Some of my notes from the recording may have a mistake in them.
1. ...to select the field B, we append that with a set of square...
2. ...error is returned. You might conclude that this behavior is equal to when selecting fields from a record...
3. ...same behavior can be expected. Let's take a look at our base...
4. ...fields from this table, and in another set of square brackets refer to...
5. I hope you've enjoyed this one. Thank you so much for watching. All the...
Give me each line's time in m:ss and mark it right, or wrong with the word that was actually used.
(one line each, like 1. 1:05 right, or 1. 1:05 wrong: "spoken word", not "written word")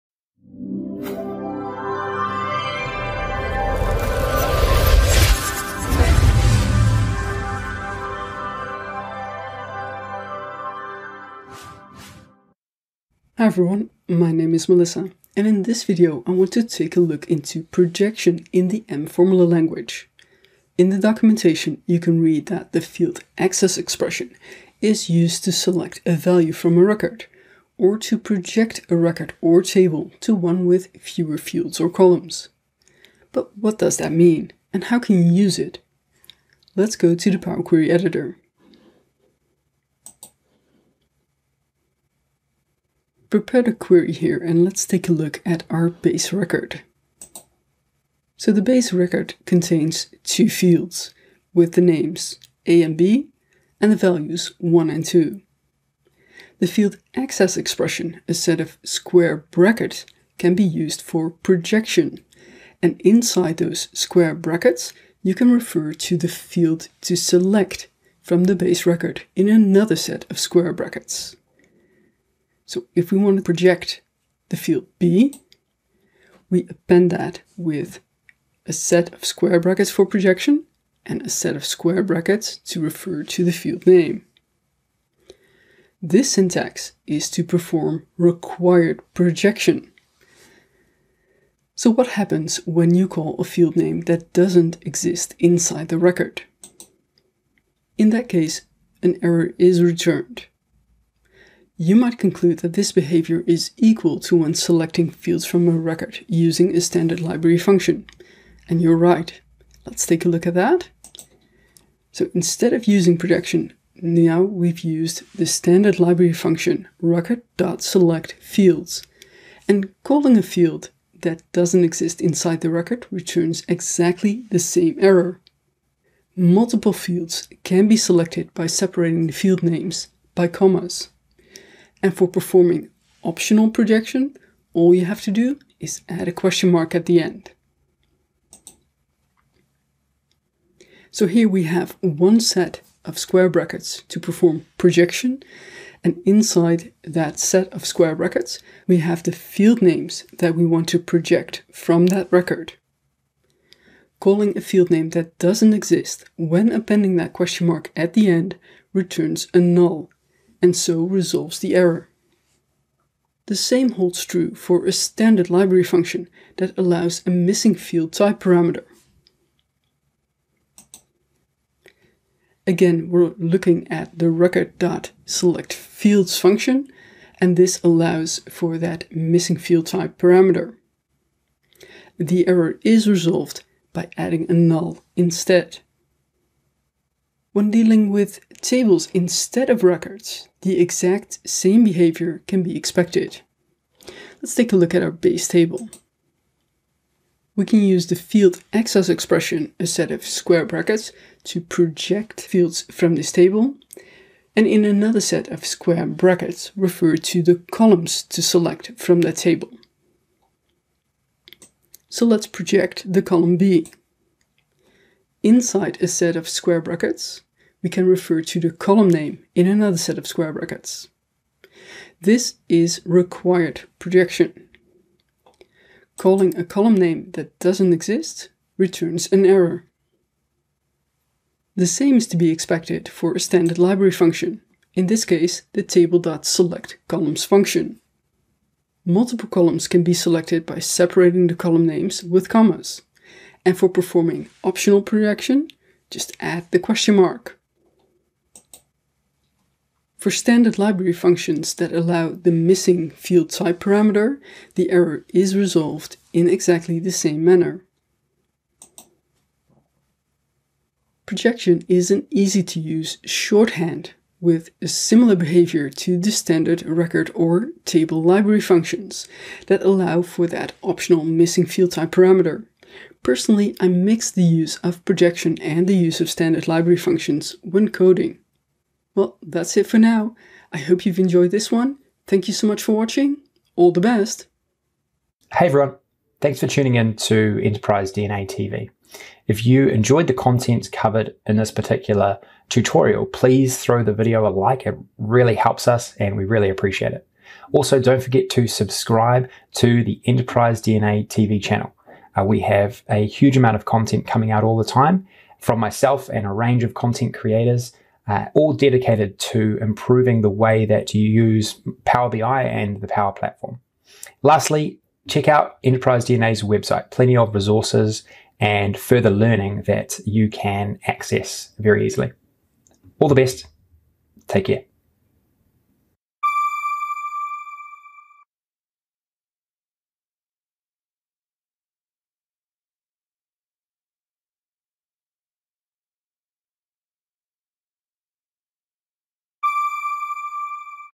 1. 1:13 wrong: "project", not "select"
2. 1:39 right
3. 3:11 right
4. 3:22 right
5. 4:40 right.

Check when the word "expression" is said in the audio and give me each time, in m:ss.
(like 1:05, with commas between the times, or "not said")
0:23, 0:57, 3:19.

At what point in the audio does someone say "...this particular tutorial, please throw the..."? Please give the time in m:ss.
4:51.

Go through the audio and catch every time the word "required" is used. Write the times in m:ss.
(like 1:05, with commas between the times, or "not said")
1:28, 3:43.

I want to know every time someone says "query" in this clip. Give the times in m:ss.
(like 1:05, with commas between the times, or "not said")
0:37, 0:43.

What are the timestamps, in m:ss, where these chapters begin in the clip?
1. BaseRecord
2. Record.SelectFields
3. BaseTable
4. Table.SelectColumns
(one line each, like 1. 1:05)
1. 0:47
2. 1:50
3. 3:15
4. 3:53.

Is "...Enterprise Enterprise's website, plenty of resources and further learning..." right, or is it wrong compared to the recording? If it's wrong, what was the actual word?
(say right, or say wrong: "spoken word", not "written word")
wrong: "DNA", not "Enterprise".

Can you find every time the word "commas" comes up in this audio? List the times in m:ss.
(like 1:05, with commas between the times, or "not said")
2:10, 4:02.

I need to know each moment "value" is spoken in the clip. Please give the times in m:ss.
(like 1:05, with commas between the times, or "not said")
0:26, 0:53.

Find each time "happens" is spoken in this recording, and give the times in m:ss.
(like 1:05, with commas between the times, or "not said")
1:32.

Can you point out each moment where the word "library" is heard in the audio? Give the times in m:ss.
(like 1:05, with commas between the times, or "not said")
1:47, 1:55, 2:45, 3:53, 4:10, 4:28, 4:36.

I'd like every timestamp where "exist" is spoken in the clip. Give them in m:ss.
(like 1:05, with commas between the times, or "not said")
1:34, 2:01, 2:35, 3:47.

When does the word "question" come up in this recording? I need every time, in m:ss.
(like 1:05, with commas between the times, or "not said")
2:16, 2:37, 4:06.